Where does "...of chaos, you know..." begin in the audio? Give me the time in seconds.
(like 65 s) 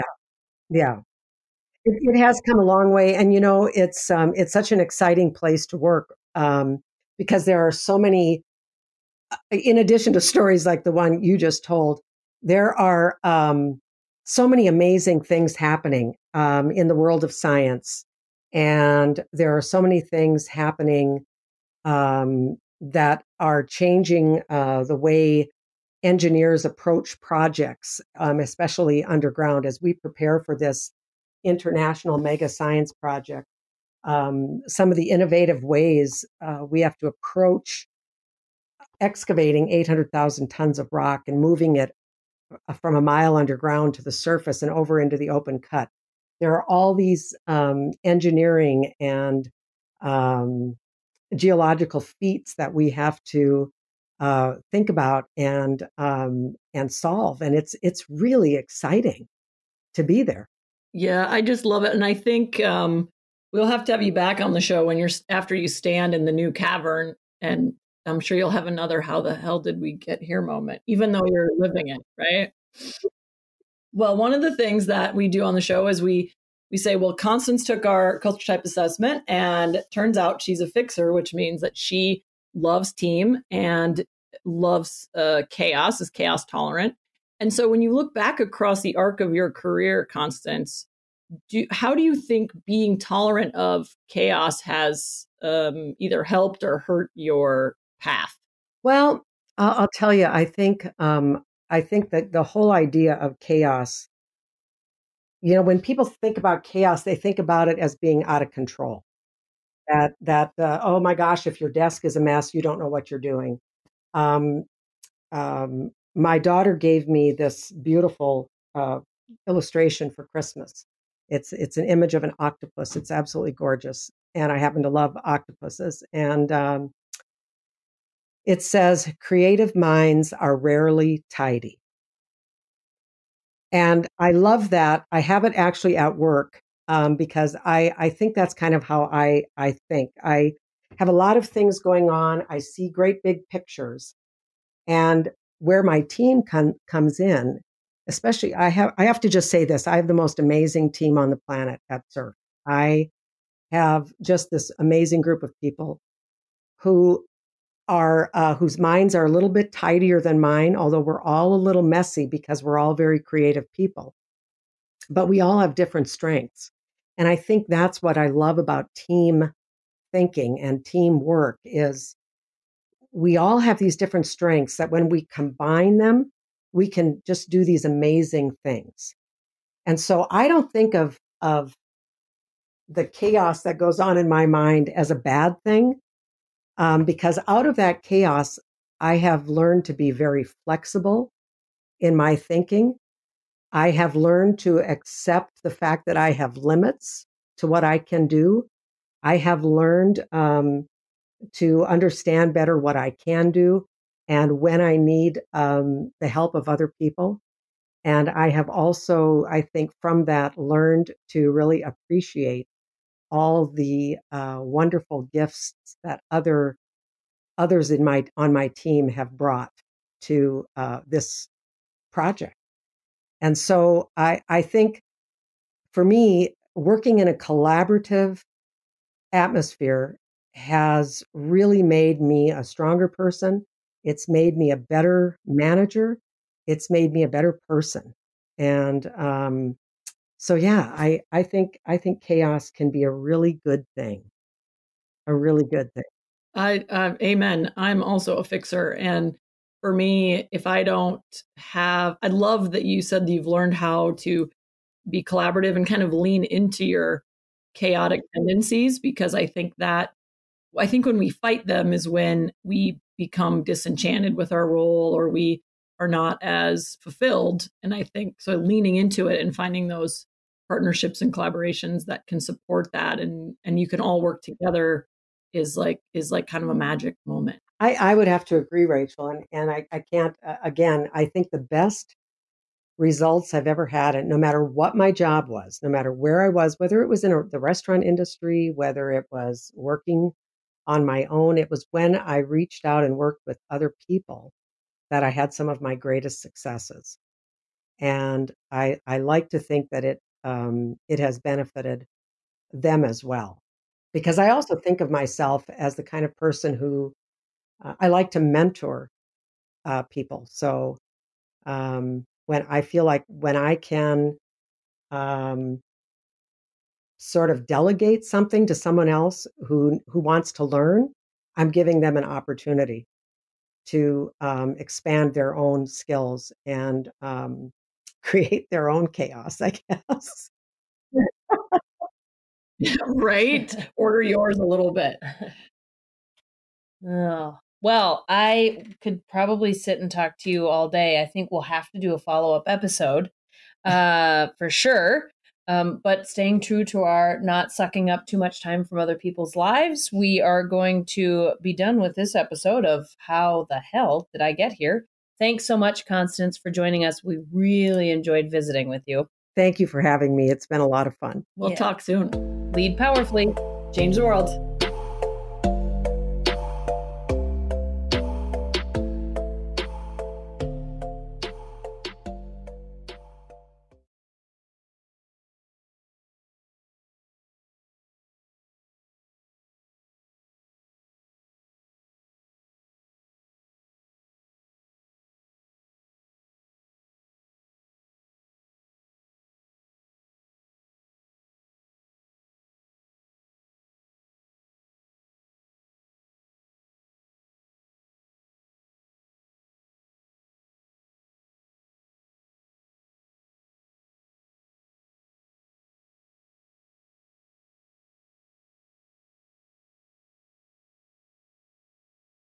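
103 s.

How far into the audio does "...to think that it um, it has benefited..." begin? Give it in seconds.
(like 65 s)
299 s.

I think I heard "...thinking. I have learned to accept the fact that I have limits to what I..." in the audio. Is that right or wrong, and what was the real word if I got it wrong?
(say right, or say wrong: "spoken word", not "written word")
right.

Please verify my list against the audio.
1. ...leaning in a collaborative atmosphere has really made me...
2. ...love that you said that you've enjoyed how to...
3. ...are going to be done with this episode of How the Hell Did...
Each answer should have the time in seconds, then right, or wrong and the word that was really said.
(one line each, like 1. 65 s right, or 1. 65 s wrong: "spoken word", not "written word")
1. 226 s wrong: "working", not "leaning"
2. 252 s wrong: "learned", not "enjoyed"
3. 350 s right.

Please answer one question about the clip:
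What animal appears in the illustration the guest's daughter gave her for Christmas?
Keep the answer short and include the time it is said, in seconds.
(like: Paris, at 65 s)
Octopus, at 122 s.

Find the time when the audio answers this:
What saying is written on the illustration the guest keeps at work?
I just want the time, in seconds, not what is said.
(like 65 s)
129 s.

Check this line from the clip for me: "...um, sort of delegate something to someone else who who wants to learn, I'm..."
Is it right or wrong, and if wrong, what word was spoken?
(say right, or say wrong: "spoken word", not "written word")
right.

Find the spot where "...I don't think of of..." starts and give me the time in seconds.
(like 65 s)
180 s.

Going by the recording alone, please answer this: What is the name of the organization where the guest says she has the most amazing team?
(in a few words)
SURF.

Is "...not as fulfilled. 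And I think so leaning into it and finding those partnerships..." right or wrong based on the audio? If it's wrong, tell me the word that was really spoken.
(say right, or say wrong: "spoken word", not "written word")
right.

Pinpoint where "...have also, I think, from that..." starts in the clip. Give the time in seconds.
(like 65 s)
208 s.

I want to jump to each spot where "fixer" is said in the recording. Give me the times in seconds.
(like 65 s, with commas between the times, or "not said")
80 s, 248 s.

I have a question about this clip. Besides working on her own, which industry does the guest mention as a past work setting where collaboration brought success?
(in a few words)
Restaurant industry.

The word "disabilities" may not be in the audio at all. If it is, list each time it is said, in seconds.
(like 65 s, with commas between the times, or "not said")
not said.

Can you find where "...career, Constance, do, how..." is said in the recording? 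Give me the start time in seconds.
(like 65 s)
89 s.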